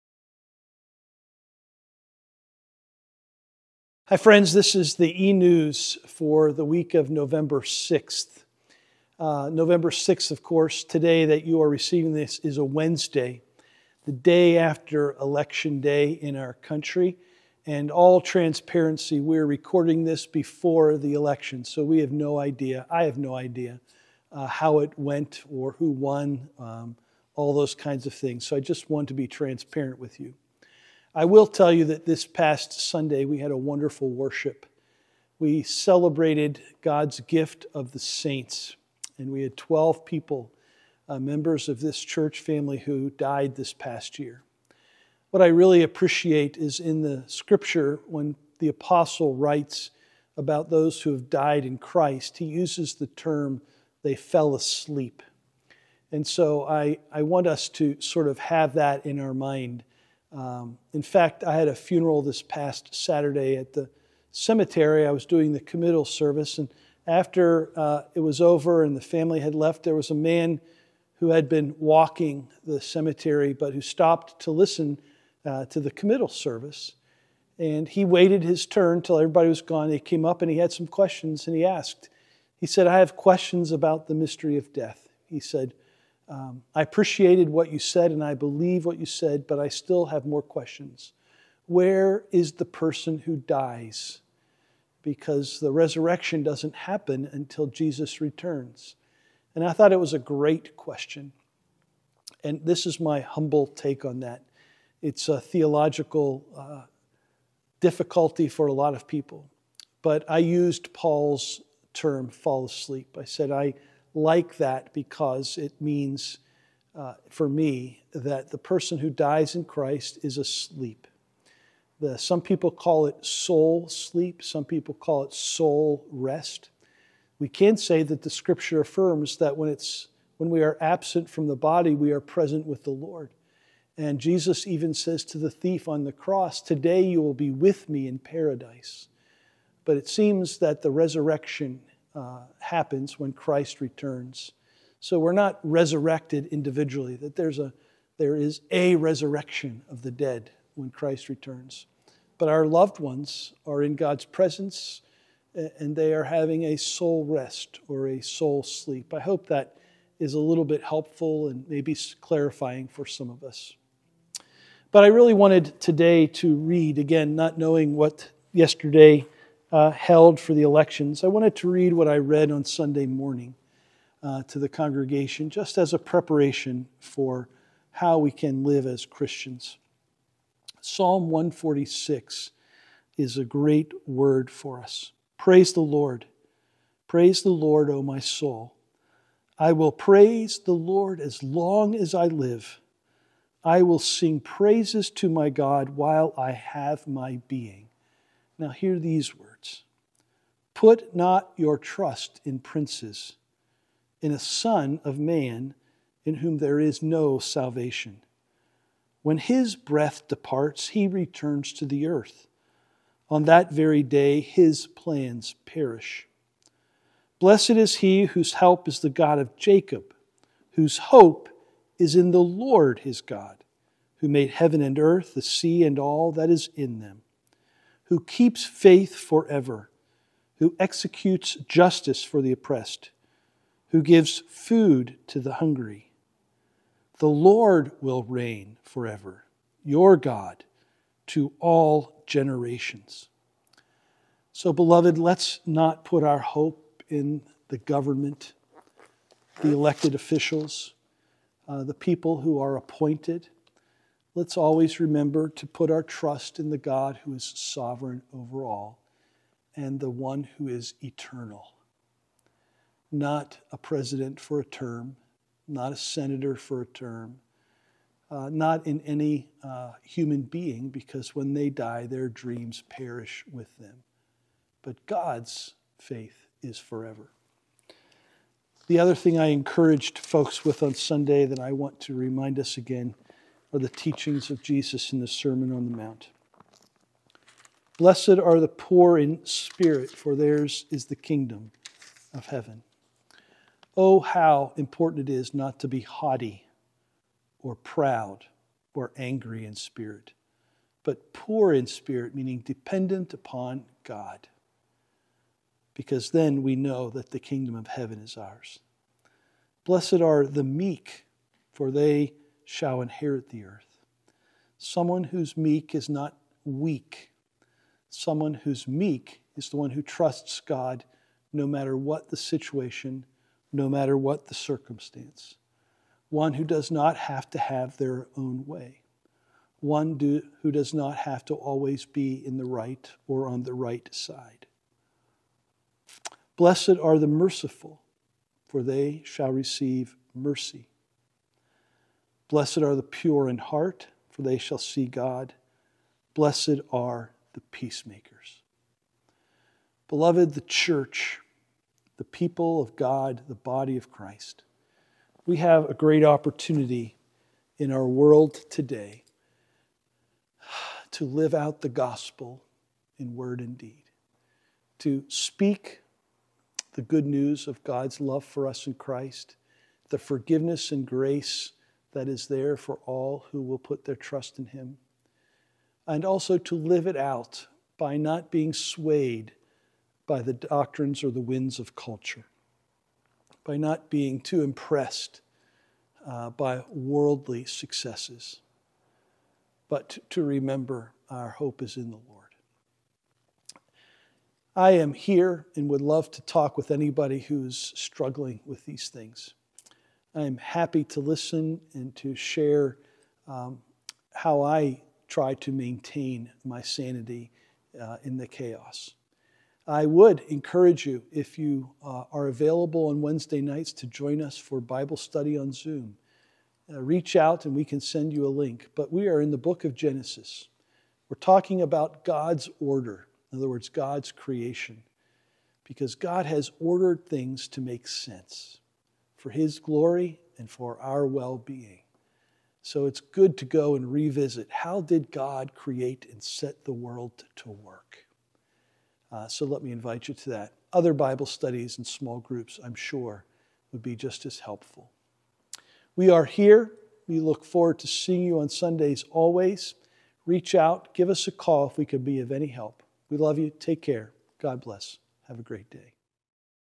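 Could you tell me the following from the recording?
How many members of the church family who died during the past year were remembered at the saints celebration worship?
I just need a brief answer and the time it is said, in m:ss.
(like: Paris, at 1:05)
12, at 0:39.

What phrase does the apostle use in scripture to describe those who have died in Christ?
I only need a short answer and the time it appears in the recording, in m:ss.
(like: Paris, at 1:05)
fell asleep, at 0:54.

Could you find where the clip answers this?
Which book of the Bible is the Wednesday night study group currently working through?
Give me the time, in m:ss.
6:59.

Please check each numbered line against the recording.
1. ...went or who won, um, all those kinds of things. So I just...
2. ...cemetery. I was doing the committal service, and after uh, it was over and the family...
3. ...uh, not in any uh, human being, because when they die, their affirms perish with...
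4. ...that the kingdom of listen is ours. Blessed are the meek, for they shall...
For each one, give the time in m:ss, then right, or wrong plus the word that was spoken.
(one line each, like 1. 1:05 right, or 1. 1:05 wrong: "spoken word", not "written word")
1. 0:24 right
2. 1:04 right
3. 4:28 wrong: "dreams", not "affirms"
4. 5:07 wrong: "heaven", not "listen".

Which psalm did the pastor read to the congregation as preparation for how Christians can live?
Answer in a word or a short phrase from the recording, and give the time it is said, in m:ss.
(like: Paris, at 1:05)
Psalm 146, at 3:00.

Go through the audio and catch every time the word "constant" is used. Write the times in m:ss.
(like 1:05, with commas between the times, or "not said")
not said.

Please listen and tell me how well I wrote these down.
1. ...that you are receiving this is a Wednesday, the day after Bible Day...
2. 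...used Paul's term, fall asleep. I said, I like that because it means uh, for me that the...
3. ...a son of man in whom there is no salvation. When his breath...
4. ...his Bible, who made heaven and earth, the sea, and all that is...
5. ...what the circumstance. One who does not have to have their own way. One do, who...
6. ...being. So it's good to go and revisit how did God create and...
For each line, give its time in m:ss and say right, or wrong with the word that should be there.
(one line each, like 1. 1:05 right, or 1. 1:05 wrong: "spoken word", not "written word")
1. 0:11 wrong: "Election", not "Bible"
2. 1:50 right
3. 3:24 right
4. 3:43 wrong: "God", not "Bible"
5. 5:24 right
6. 7:11 right.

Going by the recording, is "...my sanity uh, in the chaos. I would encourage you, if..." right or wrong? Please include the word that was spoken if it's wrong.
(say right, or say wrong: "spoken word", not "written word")
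right.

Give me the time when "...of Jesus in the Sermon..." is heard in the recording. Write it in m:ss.
4:44.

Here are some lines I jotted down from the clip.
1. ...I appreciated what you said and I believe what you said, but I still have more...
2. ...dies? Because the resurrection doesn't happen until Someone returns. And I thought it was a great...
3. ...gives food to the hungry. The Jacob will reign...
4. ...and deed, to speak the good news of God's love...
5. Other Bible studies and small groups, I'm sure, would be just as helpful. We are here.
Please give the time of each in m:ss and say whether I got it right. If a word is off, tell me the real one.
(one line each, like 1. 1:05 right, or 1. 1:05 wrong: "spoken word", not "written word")
1. 1:26 right
2. 1:33 wrong: "Jesus", not "Someone"
3. 3:54 wrong: "Lord", not "Jacob"
4. 6:03 right
5. 7:20 right.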